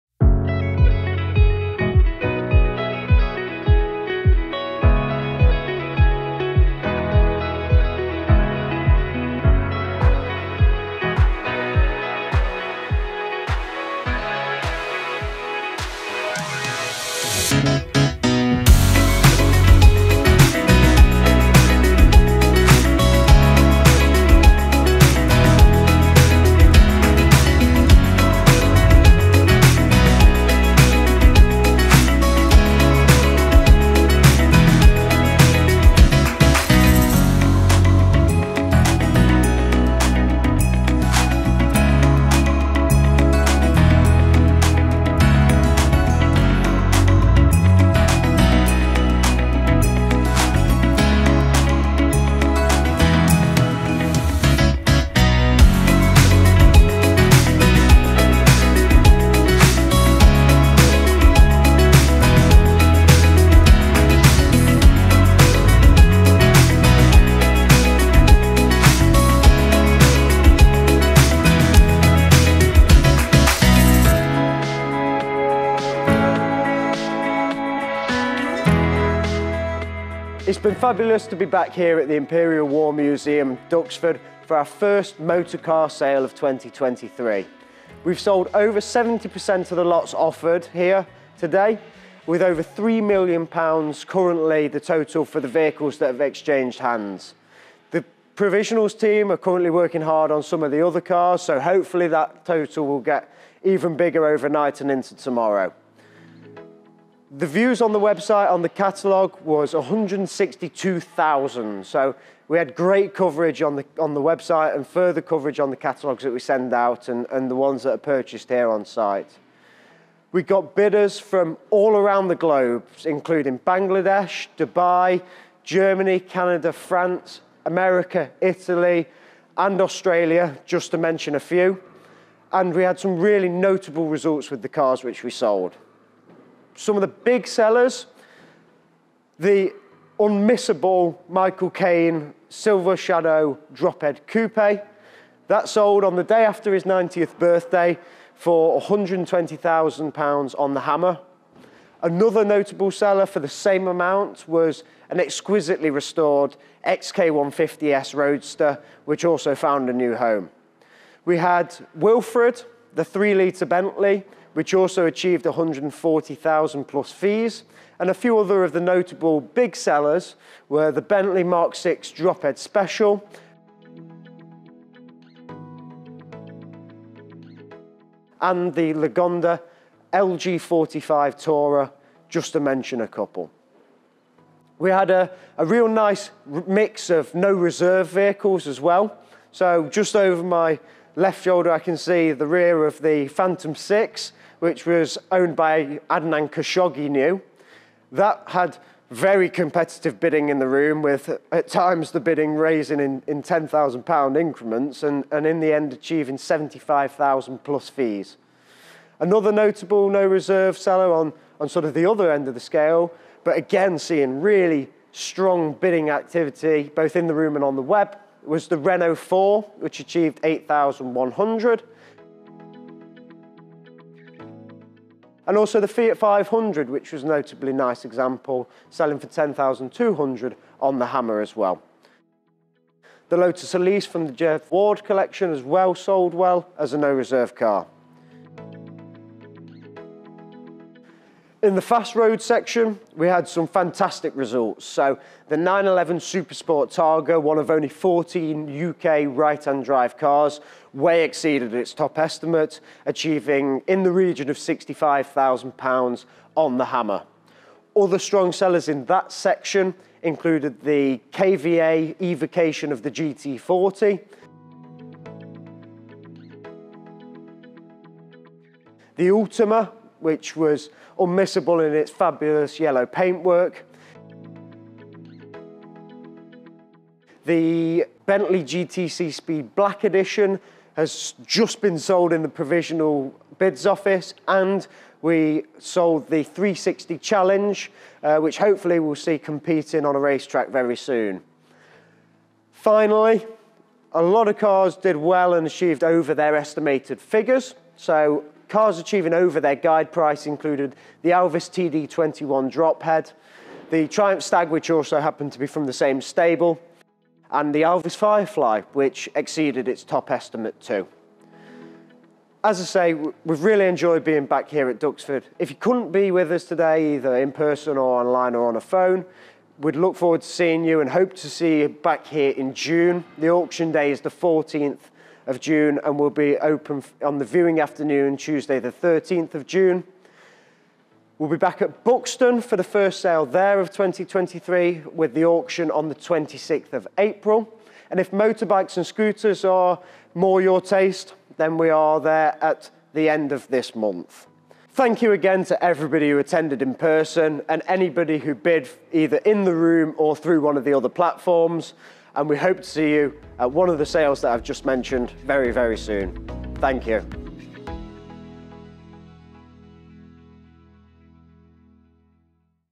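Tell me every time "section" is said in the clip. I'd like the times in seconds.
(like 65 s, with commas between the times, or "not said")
242 s, 259 s.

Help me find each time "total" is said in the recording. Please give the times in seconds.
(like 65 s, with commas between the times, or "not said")
94 s, 102 s.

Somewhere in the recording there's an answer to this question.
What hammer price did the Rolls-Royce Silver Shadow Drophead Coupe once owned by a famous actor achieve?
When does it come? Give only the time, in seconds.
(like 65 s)
148 s.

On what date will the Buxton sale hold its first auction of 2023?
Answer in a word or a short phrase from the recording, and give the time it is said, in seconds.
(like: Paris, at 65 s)
26th of April, at 336 s.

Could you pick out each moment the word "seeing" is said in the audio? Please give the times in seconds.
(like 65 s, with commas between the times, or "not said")
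213 s, 320 s.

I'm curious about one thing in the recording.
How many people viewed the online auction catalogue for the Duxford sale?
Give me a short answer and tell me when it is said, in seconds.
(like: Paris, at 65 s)
162,000, at 109 s.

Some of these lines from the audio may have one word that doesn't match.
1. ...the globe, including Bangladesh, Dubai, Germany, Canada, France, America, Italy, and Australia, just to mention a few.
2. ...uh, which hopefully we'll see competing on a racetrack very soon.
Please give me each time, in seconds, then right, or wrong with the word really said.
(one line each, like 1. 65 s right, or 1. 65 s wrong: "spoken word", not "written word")
1. 122 s right
2. 288 s right.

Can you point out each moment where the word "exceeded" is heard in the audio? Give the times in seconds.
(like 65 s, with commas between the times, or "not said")
251 s, 309 s.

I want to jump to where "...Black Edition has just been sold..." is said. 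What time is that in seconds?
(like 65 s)
279 s.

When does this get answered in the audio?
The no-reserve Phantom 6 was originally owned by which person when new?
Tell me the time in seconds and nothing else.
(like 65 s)
196 s.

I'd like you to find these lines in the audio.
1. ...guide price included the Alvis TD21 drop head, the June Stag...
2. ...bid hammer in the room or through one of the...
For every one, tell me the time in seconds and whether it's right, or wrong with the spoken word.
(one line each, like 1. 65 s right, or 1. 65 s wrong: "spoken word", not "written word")
1. 299 s wrong: "Triumph", not "June"
2. 348 s wrong: "either", not "hammer".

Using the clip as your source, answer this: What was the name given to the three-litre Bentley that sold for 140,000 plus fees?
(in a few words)
Wilfred.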